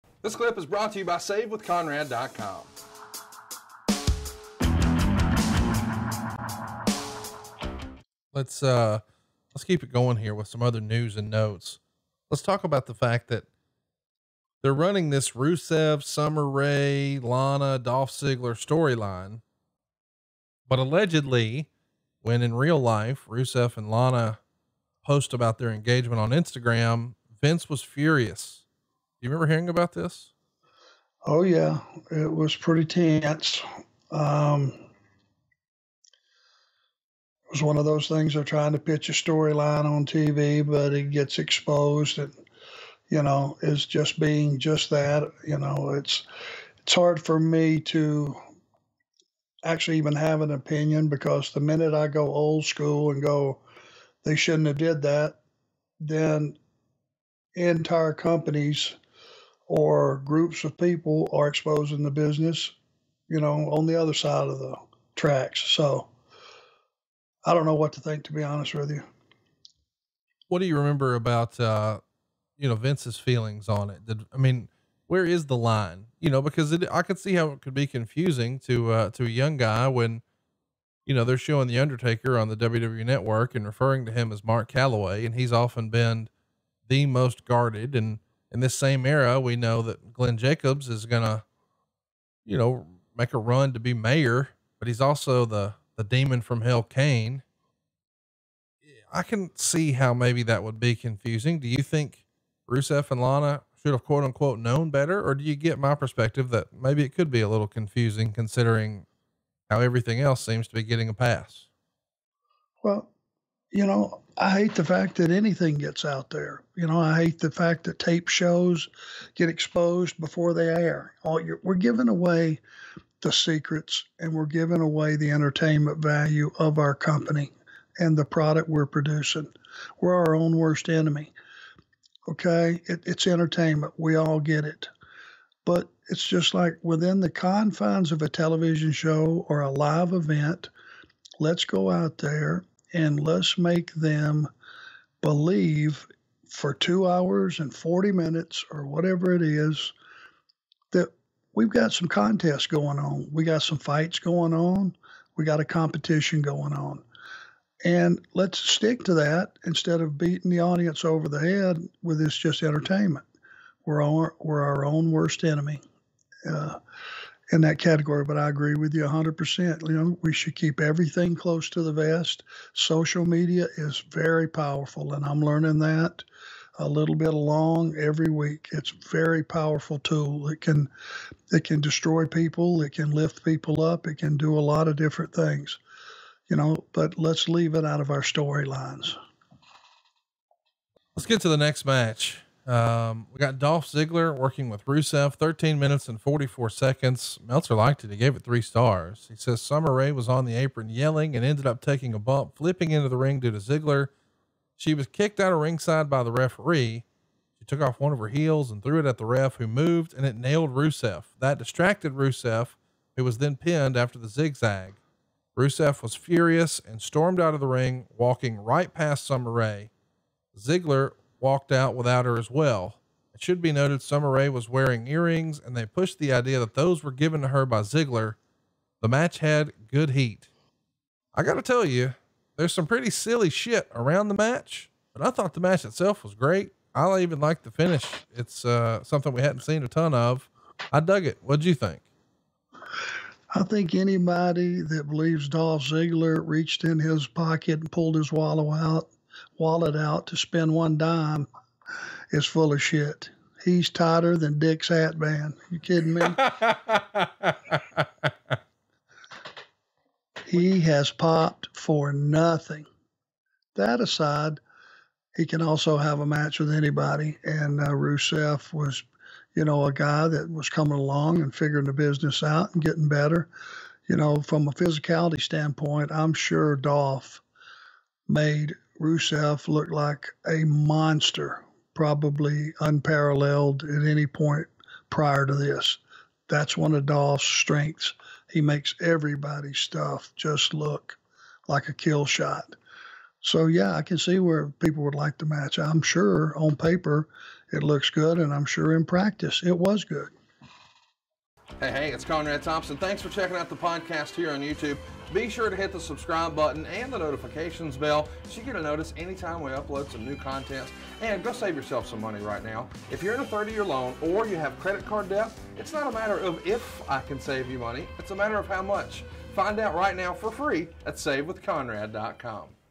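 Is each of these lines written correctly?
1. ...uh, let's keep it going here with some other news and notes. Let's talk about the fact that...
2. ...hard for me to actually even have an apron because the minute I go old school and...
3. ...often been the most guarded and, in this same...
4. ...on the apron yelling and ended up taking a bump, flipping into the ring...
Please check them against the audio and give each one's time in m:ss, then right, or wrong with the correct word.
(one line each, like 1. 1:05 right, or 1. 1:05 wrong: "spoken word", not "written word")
1. 0:08 right
2. 0:46 wrong: "opinion", not "apron"
3. 1:25 right
4. 3:20 right.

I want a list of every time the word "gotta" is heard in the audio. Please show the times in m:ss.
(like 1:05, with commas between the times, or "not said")
3:51.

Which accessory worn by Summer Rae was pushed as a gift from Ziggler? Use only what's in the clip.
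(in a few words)
Earrings.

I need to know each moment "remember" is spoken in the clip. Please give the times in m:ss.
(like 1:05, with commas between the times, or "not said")
0:29, 1:10.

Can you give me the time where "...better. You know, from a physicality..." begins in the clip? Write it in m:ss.
4:33.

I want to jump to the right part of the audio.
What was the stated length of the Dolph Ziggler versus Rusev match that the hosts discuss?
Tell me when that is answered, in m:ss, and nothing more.
3:15.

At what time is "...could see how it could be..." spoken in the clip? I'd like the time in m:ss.
1:17.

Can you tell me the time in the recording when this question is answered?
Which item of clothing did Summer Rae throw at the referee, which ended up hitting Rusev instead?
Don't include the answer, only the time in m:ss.
3:27.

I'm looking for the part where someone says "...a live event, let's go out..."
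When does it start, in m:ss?
2:19.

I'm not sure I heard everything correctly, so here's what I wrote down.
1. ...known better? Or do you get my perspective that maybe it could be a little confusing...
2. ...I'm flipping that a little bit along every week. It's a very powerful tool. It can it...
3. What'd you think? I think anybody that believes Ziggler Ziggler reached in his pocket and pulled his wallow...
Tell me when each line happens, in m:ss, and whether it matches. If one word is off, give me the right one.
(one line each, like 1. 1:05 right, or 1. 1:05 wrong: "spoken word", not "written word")
1. 1:44 right
2. 2:55 wrong: "learning", not "flipping"
3. 4:01 wrong: "Dolph", not "Ziggler".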